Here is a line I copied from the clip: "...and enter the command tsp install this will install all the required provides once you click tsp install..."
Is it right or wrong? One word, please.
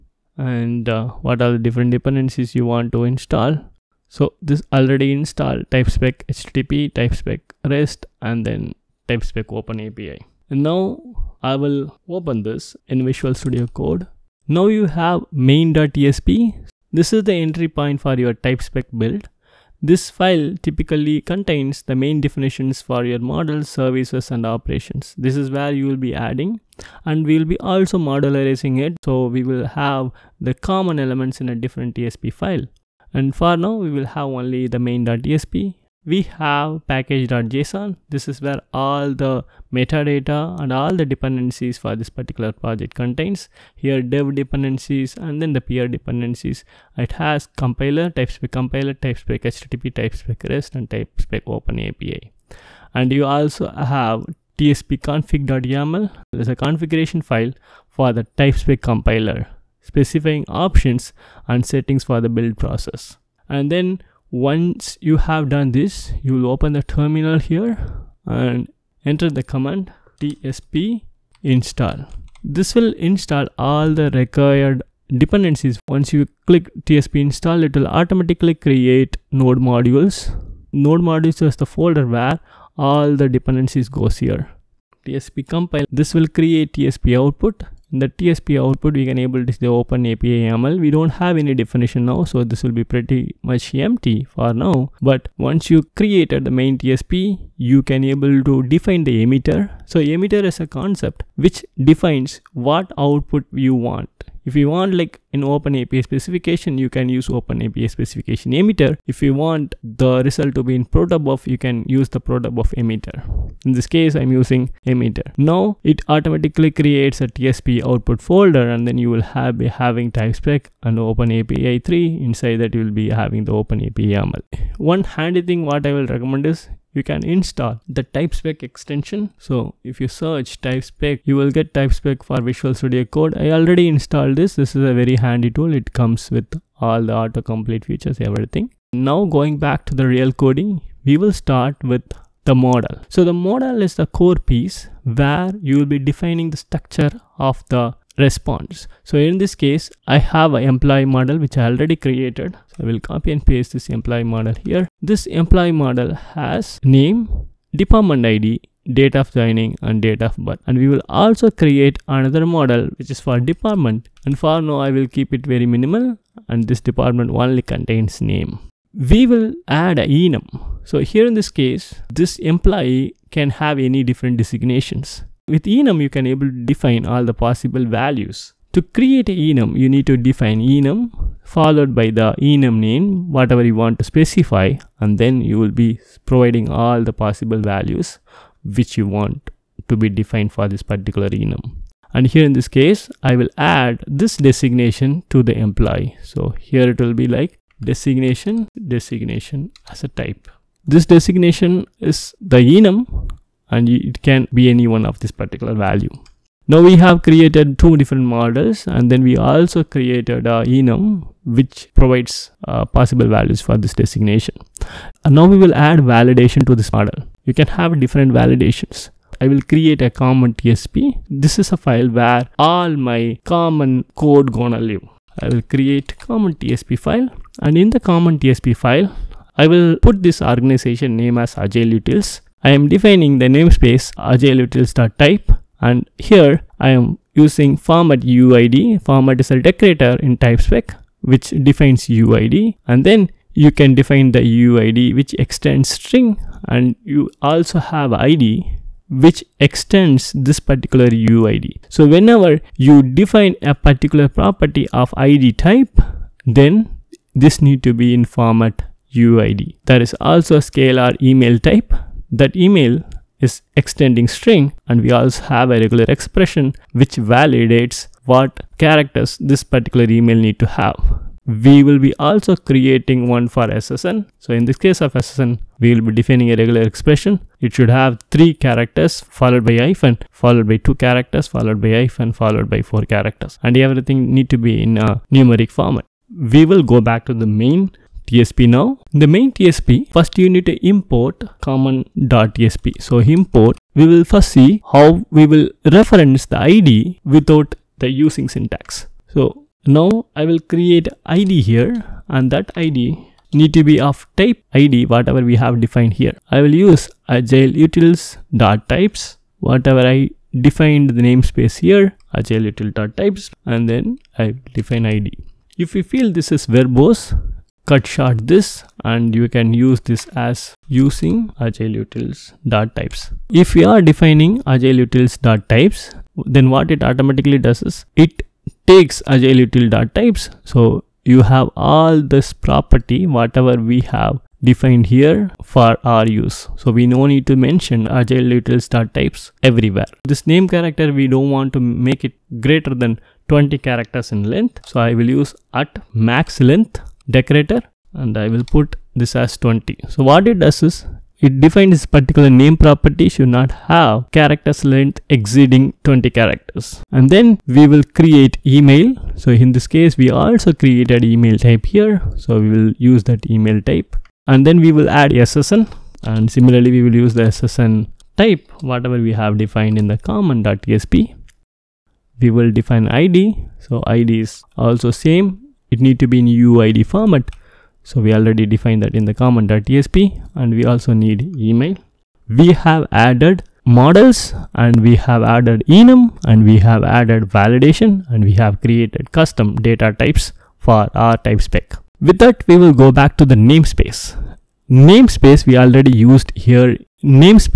wrong.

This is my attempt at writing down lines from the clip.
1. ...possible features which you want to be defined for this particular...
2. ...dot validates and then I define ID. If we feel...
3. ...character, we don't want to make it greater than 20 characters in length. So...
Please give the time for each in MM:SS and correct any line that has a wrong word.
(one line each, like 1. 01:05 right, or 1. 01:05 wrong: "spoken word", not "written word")
1. 03:07 wrong: "values", not "features"
2. 05:12 wrong: "types", not "validates"
3. 05:40 right.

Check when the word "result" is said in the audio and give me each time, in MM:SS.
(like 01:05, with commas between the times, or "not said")
01:50.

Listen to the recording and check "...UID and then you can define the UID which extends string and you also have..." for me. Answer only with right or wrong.
right.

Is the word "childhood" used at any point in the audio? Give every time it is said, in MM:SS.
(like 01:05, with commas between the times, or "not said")
not said.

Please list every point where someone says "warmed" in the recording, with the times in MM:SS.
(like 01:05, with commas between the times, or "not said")
not said.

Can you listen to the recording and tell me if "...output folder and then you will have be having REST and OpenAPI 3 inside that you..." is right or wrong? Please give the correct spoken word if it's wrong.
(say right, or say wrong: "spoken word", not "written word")
wrong: "TypeSpec", not "REST".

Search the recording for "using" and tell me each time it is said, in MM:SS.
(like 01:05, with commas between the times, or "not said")
01:54, 03:57, 04:58, 05:20.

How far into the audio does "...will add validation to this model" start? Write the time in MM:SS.
03:35.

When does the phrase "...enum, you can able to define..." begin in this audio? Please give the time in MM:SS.
02:55.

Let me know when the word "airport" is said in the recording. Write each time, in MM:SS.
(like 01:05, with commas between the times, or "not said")
not said.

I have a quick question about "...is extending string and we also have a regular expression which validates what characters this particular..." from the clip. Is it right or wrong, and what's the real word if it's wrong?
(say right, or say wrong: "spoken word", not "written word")
right.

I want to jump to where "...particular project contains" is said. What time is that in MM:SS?
00:42.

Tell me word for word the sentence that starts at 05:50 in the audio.
So what it does is it defines this particular name property should not have characters length exceeding 20 characters.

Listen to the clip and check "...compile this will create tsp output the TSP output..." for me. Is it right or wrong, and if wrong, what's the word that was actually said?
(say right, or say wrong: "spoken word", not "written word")
right.